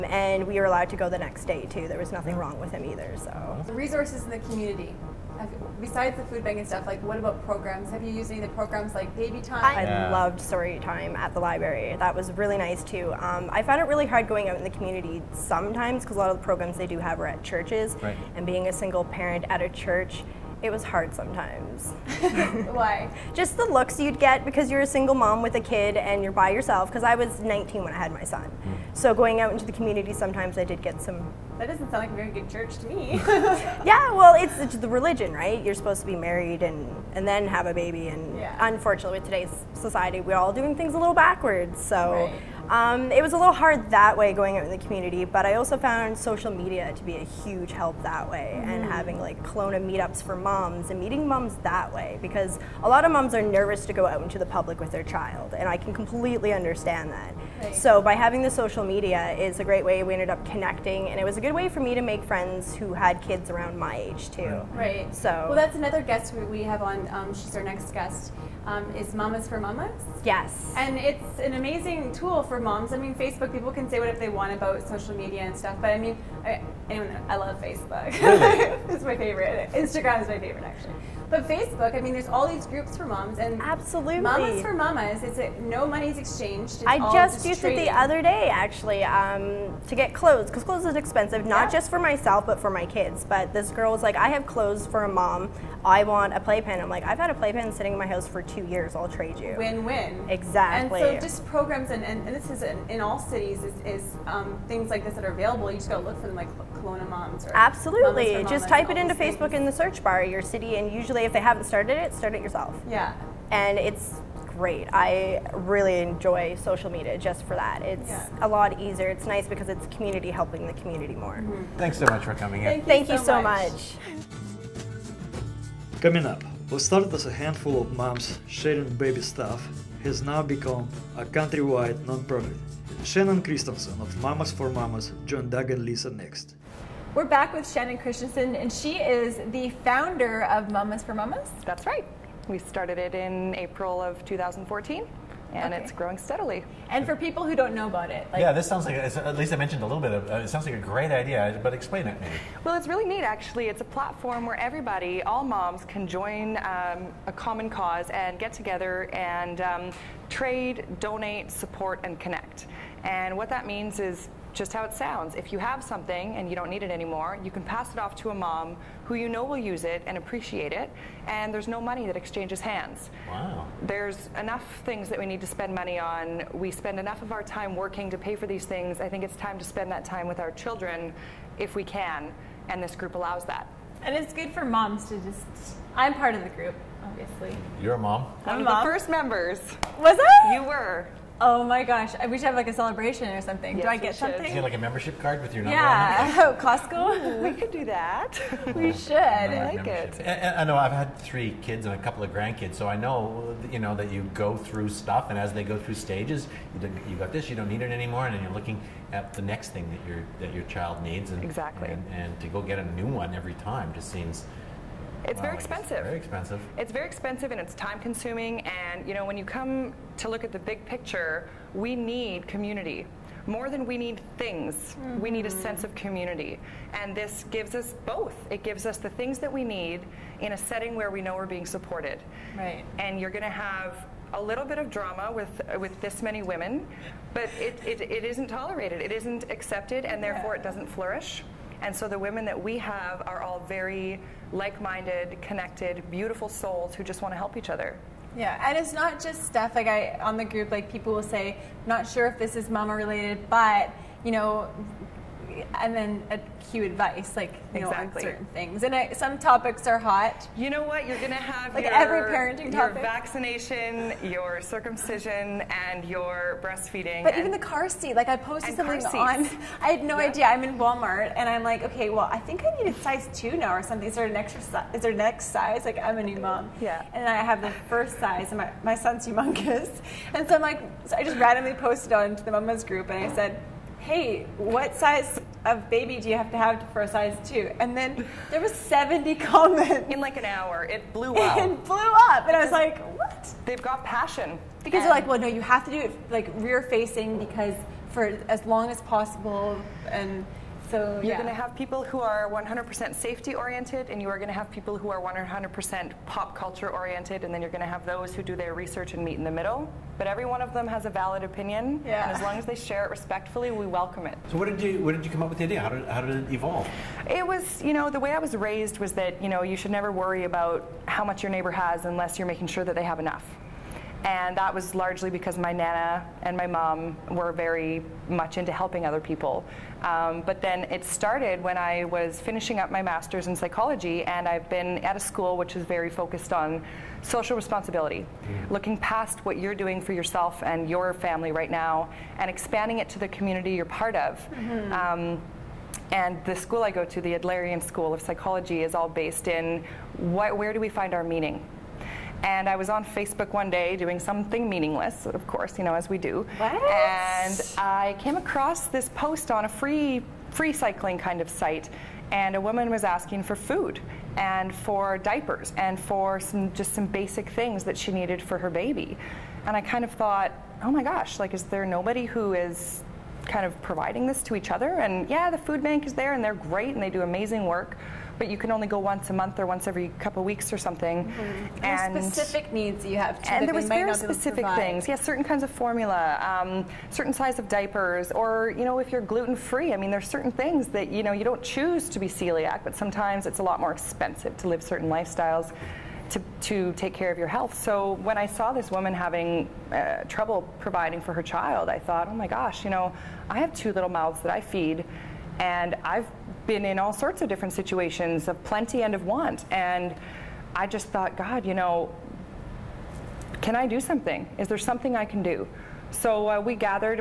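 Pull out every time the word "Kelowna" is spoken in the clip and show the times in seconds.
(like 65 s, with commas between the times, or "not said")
49 s, 106 s.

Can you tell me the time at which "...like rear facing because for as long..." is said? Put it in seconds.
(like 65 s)
296 s.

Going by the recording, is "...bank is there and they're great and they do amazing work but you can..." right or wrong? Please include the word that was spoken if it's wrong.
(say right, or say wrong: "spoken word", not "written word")
right.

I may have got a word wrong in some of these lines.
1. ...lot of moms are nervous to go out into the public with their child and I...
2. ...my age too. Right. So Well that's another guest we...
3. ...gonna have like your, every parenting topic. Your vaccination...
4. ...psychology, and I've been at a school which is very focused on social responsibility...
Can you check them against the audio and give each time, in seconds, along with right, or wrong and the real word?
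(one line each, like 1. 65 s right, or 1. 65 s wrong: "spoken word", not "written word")
1. 52 s right
2. 63 s right
3. 261 s right
4. 333 s right.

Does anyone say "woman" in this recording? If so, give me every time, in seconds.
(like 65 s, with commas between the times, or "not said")
362 s, 398 s.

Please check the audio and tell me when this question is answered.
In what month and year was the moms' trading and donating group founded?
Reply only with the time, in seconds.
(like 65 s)
143 s.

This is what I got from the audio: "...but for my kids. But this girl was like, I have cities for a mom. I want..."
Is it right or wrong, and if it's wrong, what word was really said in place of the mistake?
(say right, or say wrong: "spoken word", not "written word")
wrong: "clothes", not "cities".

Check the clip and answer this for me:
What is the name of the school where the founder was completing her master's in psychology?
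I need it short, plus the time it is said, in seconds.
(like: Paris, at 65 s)
Adlerian School of Psychology, at 347 s.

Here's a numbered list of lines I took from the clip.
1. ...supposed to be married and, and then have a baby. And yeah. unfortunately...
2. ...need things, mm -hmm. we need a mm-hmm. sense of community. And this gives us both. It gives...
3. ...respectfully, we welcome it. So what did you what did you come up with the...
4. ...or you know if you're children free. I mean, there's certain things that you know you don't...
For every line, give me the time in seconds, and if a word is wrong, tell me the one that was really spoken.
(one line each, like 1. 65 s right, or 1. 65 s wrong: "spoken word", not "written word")
1. 35 s right
2. 223 s right
3. 313 s right
4. 388 s wrong: "gluten", not "children".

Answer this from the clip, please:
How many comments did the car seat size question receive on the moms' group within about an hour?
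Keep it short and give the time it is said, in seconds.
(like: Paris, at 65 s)
70, at 288 s.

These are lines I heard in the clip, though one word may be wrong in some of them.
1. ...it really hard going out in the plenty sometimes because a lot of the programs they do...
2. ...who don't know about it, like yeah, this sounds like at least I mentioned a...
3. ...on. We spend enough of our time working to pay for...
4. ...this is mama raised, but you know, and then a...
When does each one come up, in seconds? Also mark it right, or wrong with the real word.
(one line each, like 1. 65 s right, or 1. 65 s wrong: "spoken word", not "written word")
1. 13 s wrong: "community", not "plenty"
2. 147 s right
3. 175 s right
4. 252 s wrong: "related", not "raised".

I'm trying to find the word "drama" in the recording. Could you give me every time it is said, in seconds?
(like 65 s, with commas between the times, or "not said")
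234 s.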